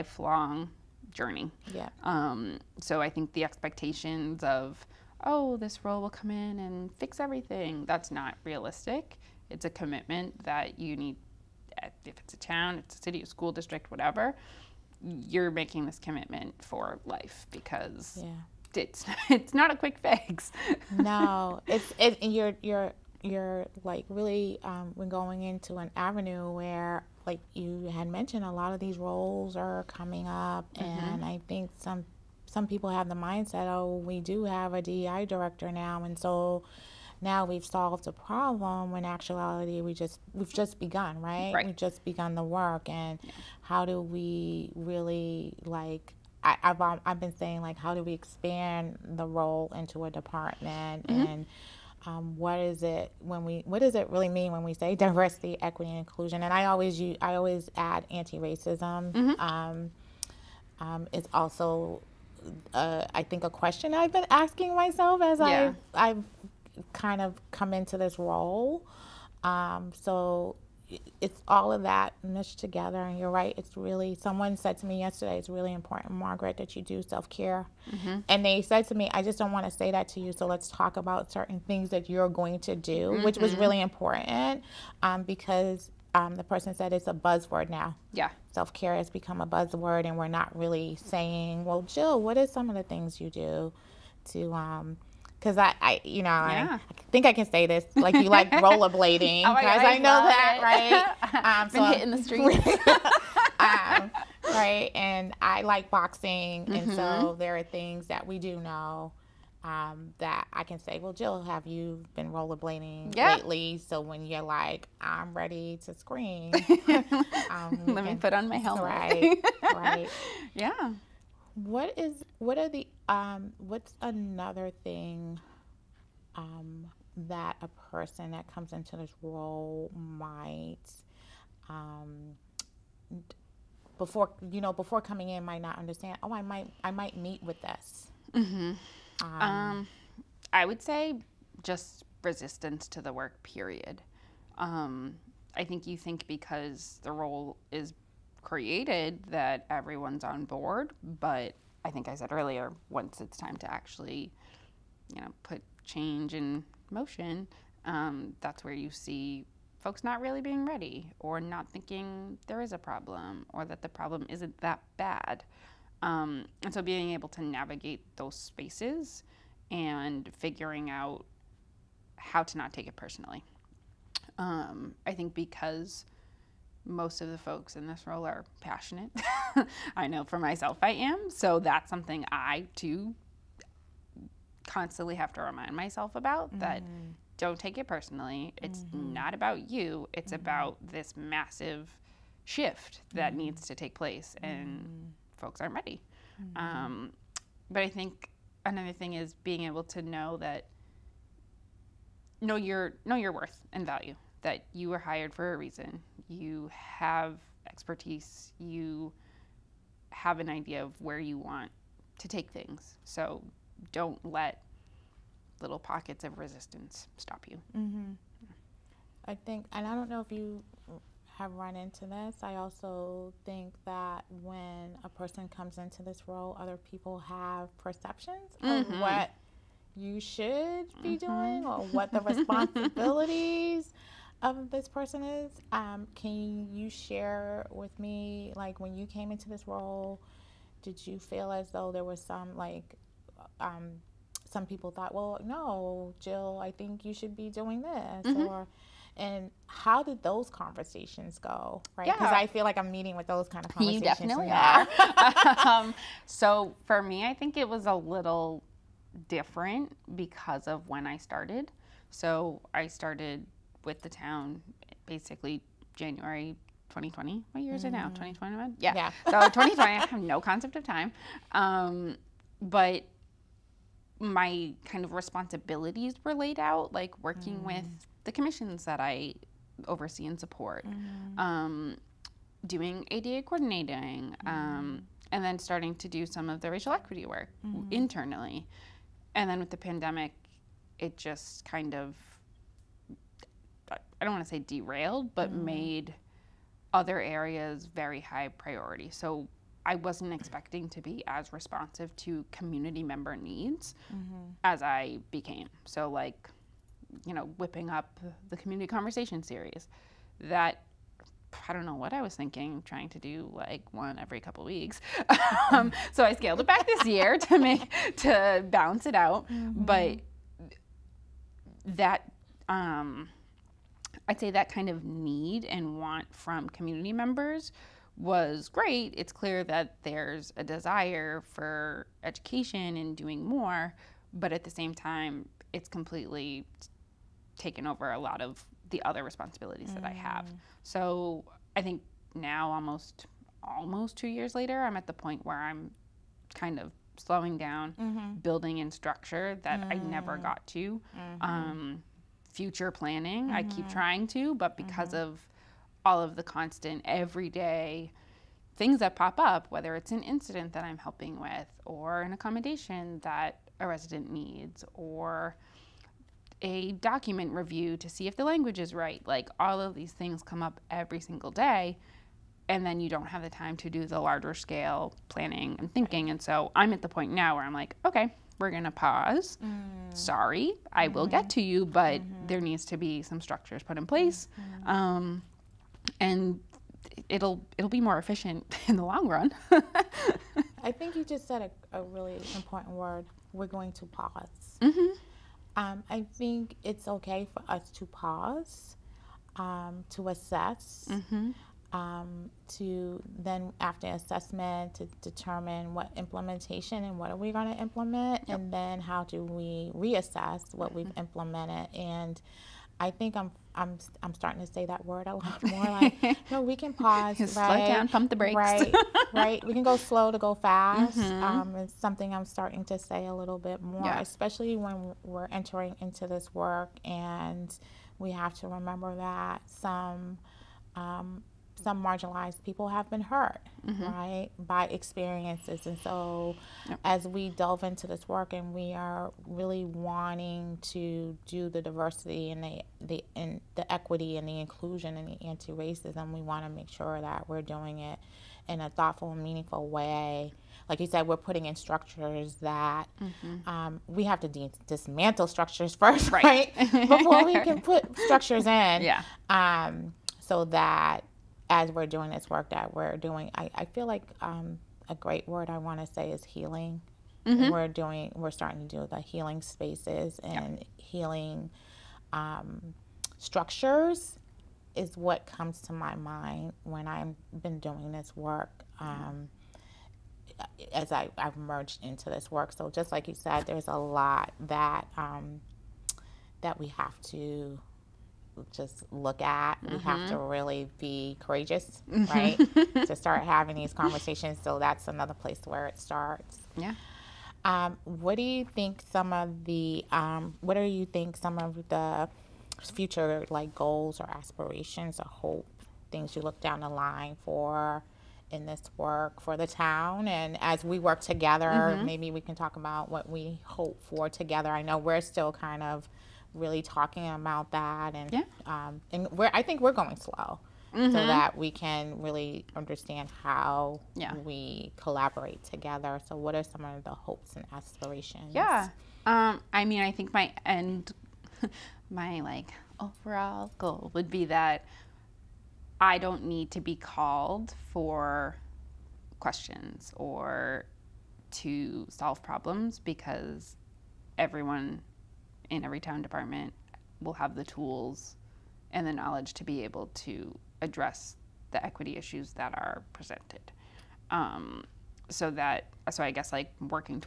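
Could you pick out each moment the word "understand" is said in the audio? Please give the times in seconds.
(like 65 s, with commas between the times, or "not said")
135 s, 522 s.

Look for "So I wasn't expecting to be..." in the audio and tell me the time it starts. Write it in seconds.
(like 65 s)
299 s.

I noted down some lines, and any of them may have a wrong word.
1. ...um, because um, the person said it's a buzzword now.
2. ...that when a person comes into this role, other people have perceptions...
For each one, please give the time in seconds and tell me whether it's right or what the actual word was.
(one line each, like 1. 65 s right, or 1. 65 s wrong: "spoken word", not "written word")
1. 85 s right
2. 223 s right.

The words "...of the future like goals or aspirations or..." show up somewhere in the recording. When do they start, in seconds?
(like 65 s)
501 s.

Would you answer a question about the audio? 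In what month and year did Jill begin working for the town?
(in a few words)
January 2020.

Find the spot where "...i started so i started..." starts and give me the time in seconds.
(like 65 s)
261 s.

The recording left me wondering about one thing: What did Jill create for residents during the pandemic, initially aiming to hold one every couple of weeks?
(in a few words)
community conversation series.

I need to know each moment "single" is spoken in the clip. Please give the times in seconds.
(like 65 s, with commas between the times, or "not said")
371 s.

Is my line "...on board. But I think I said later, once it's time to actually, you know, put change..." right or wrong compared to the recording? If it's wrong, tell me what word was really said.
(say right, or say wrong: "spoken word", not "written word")
wrong: "earlier", not "later".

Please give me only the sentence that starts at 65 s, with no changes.
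i've, I've kind of come into this role.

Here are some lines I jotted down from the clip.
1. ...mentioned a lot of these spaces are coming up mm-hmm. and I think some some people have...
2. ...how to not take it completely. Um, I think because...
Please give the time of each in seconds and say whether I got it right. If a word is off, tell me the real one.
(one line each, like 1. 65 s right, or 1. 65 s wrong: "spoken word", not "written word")
1. 28 s wrong: "roles", not "spaces"
2. 172 s wrong: "personally", not "completely".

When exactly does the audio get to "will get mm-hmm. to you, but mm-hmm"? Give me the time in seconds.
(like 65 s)
381 s.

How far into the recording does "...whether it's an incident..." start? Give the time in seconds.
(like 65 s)
359 s.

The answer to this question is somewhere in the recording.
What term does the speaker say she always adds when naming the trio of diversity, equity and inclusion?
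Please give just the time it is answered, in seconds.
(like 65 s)
58 s.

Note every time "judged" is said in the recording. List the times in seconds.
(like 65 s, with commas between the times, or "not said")
not said.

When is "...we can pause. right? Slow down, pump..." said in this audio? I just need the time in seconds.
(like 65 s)
416 s.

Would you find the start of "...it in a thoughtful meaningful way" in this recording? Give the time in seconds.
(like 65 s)
447 s.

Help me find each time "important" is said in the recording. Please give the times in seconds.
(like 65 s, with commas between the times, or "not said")
75 s, 83 s, 392 s.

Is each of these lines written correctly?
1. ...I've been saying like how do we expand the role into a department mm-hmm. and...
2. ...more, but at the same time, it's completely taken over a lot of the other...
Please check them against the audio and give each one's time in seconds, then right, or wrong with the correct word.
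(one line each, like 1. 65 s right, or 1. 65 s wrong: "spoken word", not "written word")
1. 47 s right
2. 333 s right.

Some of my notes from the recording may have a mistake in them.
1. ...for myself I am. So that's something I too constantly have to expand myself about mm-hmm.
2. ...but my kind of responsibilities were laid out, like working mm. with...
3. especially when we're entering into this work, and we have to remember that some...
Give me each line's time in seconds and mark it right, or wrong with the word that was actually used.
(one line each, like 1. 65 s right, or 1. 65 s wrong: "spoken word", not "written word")
1. 180 s wrong: "remind", not "expand"
2. 272 s right
3. 424 s right.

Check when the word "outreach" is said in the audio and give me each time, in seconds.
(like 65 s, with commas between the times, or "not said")
not said.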